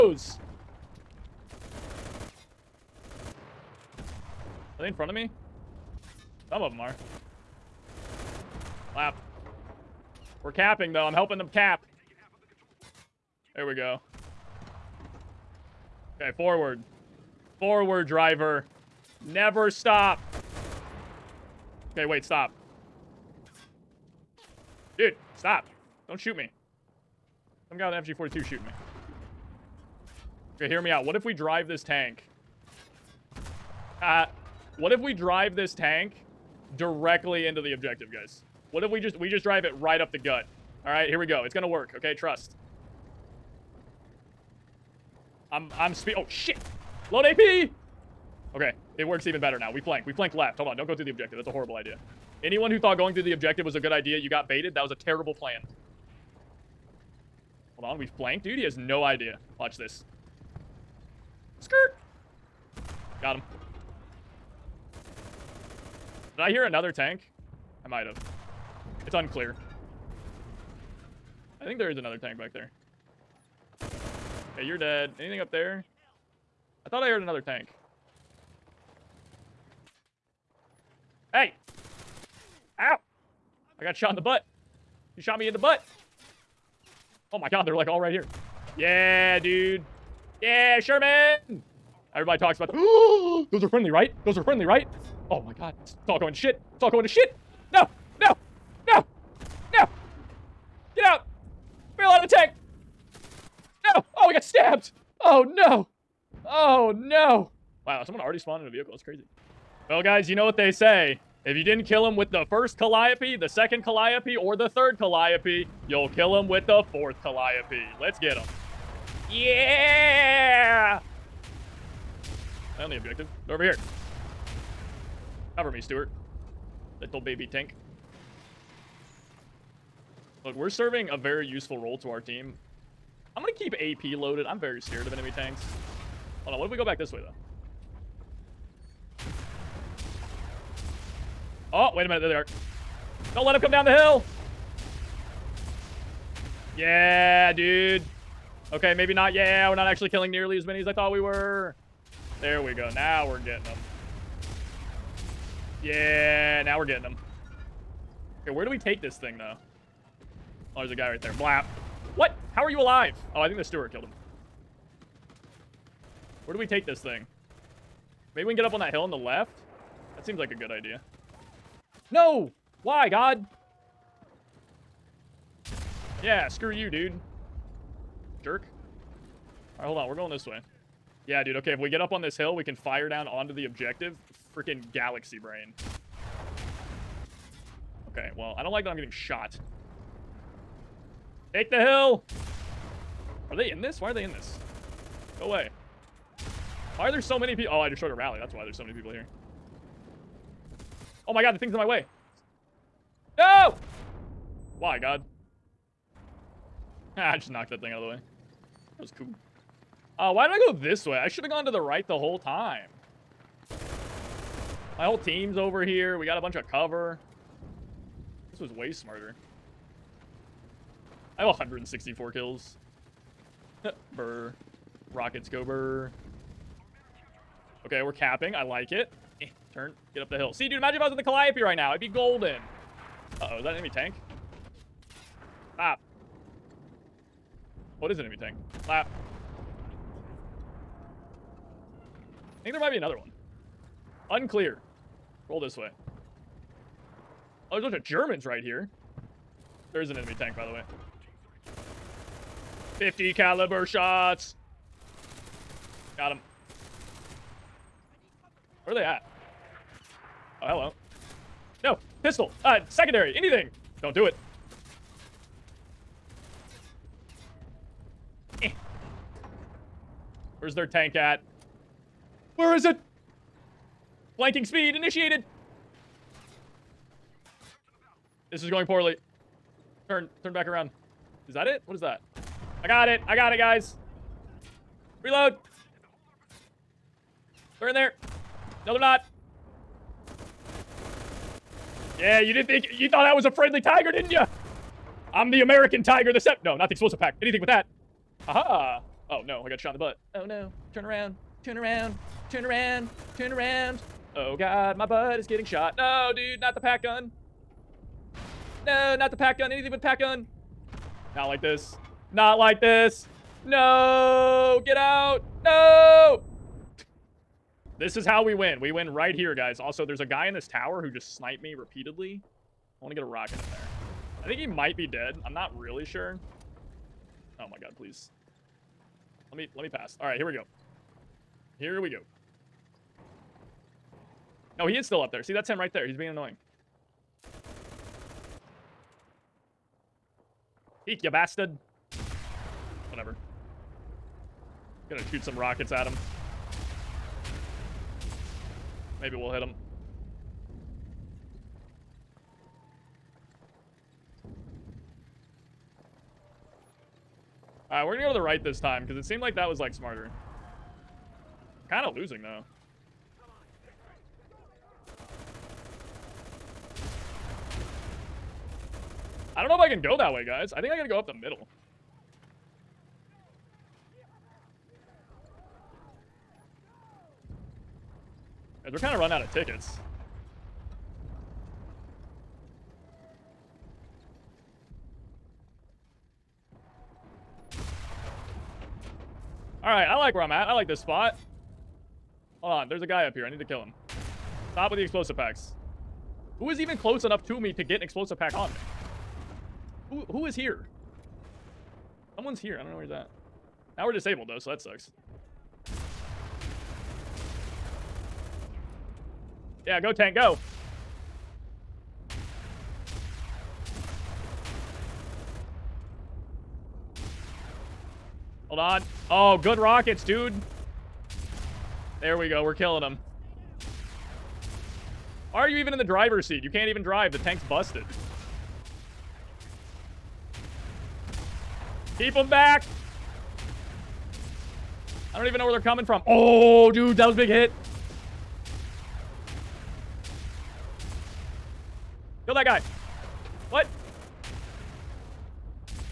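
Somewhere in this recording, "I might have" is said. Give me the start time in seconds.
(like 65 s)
67 s.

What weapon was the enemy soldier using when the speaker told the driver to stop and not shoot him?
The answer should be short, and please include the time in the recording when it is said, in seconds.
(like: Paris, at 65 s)
FG-42, at 28 s.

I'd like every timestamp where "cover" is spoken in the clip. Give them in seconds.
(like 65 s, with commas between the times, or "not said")
125 s, 216 s.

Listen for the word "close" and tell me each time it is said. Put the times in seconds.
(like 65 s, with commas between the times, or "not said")
396 s.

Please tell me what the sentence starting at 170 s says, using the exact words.
That seems like a good idea.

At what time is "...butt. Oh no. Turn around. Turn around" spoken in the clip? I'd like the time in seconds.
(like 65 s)
299 s.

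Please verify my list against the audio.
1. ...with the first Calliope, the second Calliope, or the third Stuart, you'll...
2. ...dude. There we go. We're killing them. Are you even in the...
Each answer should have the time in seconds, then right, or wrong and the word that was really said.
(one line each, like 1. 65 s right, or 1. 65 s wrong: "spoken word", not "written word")
1. 112 s wrong: "Calliope", not "Stuart"
2. 420 s right.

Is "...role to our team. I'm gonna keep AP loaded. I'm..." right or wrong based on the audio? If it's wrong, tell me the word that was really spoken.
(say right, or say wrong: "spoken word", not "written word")
right.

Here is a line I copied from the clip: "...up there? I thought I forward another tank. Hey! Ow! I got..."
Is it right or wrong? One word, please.
wrong.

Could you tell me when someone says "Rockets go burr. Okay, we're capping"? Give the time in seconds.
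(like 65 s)
225 s.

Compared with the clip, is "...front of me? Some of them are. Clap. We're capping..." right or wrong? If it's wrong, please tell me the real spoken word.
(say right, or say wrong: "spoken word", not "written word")
right.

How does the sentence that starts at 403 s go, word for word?
Now we're disabled, though, so that sucks.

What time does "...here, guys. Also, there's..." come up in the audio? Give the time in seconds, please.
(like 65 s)
319 s.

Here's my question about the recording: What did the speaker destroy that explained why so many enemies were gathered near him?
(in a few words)
A rally.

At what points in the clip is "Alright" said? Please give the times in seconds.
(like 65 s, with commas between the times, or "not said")
179 s, 357 s.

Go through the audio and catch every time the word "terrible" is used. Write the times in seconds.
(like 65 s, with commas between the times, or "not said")
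54 s.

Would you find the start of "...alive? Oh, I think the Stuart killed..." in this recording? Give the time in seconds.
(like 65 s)
162 s.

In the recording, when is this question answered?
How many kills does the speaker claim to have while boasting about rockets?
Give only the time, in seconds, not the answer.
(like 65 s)
221 s.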